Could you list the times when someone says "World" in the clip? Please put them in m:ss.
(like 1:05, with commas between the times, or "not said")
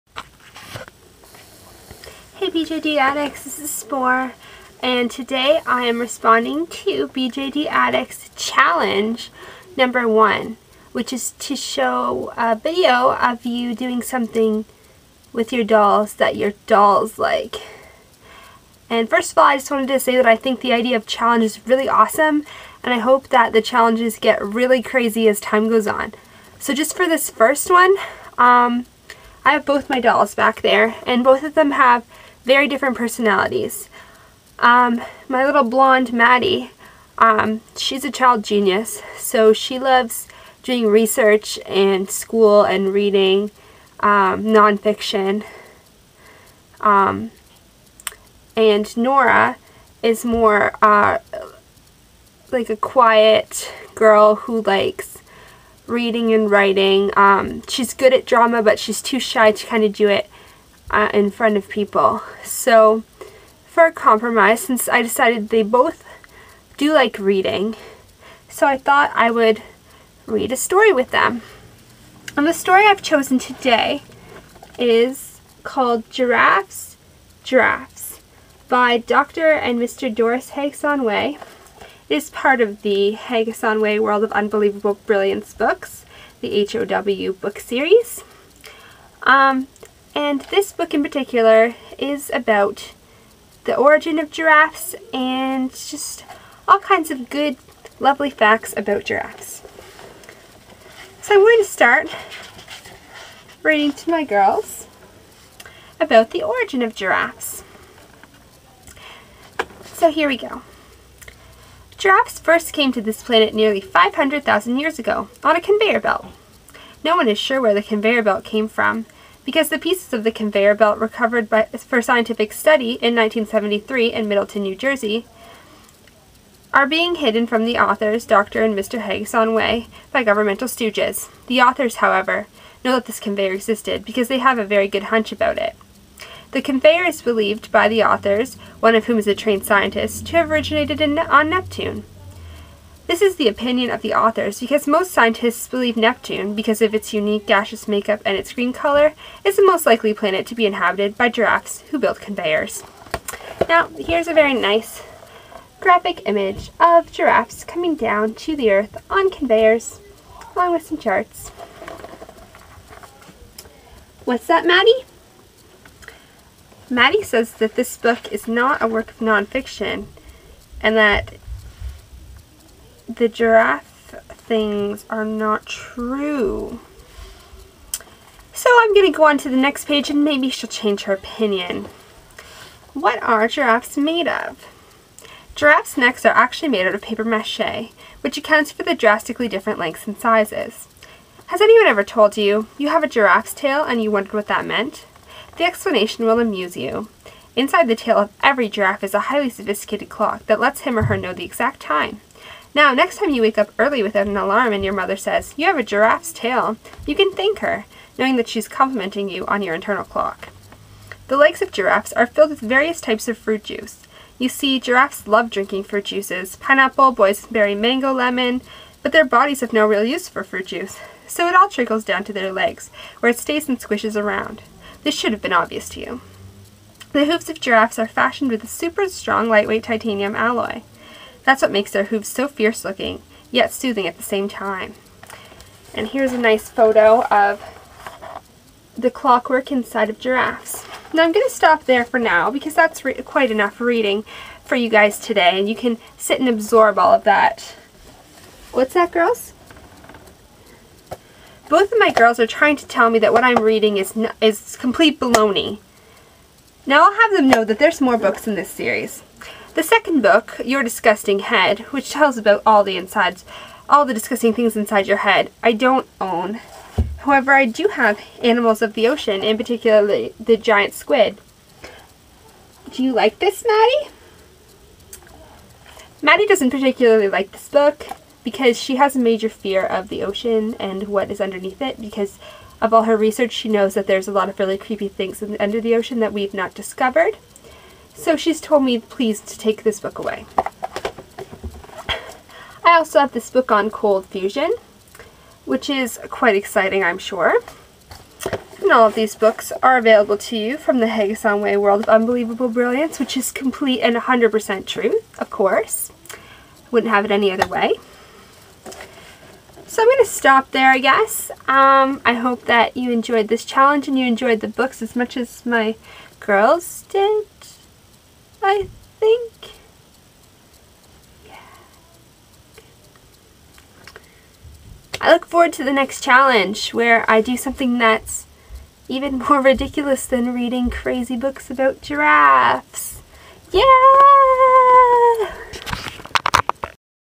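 1:23, 5:01.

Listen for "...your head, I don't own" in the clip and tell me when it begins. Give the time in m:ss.
4:25.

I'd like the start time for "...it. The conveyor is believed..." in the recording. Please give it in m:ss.
2:15.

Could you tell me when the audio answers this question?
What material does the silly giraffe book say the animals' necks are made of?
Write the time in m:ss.
3:07.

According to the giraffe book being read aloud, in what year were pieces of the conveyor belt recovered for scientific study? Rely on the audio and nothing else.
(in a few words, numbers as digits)
1973.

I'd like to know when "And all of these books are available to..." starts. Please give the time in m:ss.
4:58.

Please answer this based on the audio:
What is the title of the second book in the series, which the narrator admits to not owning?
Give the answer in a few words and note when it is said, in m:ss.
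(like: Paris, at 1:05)
Your Disgusting Head, at 4:20.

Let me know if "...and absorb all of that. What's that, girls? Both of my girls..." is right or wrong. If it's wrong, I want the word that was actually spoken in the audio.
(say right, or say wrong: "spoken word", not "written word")
right.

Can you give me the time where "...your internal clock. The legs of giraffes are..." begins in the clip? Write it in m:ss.
3:29.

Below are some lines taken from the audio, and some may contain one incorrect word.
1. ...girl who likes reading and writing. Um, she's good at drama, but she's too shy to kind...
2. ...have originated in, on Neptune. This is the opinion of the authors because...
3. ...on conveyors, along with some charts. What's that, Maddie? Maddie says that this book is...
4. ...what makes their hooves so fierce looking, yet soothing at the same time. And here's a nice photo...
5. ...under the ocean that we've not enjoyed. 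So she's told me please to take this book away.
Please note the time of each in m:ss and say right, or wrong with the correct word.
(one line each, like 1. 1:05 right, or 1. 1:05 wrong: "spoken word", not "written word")
1. 0:53 right
2. 2:20 right
3. 2:39 right
4. 3:51 right
5. 4:45 wrong: "discovered", not "enjoyed".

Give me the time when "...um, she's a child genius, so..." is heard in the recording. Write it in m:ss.
0:37.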